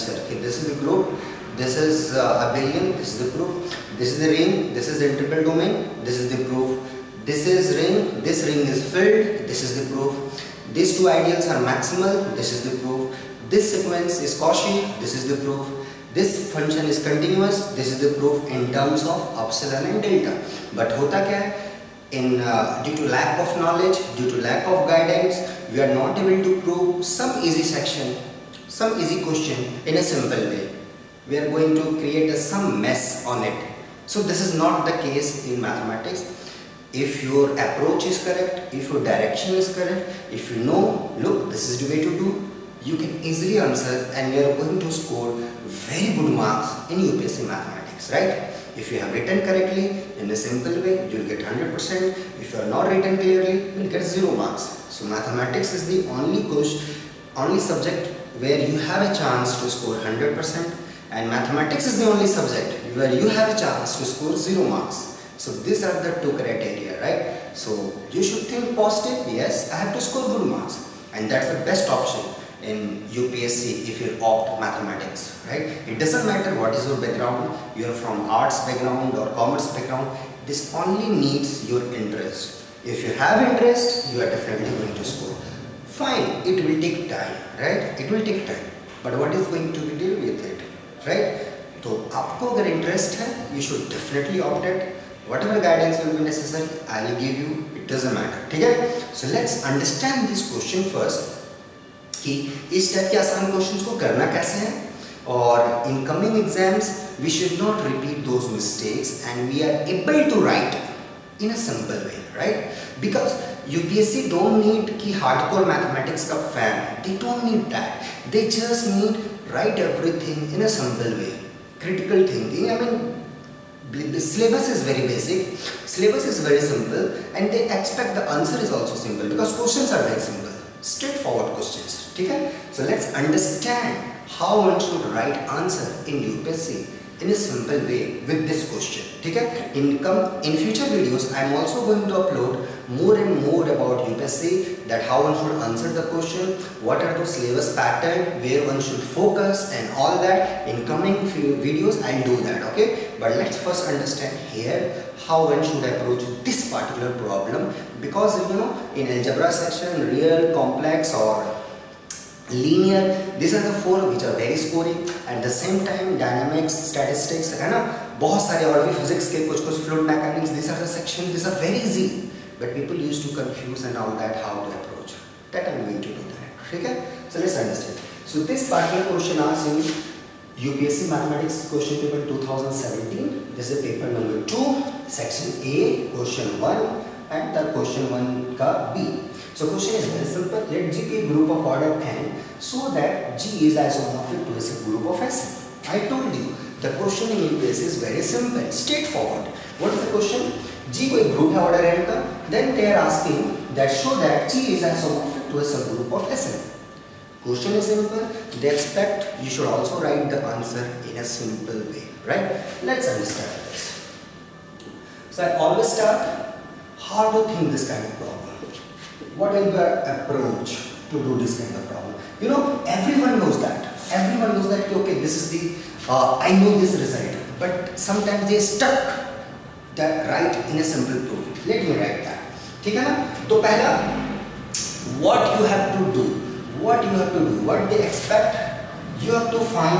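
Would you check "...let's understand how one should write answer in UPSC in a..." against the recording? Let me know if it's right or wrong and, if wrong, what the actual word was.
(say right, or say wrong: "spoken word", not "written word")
right.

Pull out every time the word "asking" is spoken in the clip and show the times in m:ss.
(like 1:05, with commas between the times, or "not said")
3:23.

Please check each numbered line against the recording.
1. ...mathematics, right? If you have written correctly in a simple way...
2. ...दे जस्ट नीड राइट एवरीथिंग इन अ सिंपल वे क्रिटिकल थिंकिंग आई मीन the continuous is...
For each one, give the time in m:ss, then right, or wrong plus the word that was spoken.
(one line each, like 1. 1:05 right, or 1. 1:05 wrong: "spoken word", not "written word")
1. 0:47 right
2. 1:58 wrong: "syllabus", not "continuous".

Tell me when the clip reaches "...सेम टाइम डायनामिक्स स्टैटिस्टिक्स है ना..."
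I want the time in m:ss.
2:45.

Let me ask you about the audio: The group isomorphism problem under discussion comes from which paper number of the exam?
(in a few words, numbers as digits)
Paper 2.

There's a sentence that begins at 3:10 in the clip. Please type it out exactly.
Let G be a group of order n so that G is isomorphic to a subgroup of S.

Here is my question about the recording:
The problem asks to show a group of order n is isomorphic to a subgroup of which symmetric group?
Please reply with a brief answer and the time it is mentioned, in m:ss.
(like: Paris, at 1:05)
Sn, at 3:26.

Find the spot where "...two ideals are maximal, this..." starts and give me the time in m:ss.
0:10.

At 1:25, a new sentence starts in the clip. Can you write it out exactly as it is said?
Fine, it will take time, right?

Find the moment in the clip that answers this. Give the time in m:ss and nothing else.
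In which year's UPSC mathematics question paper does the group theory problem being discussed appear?
3:02.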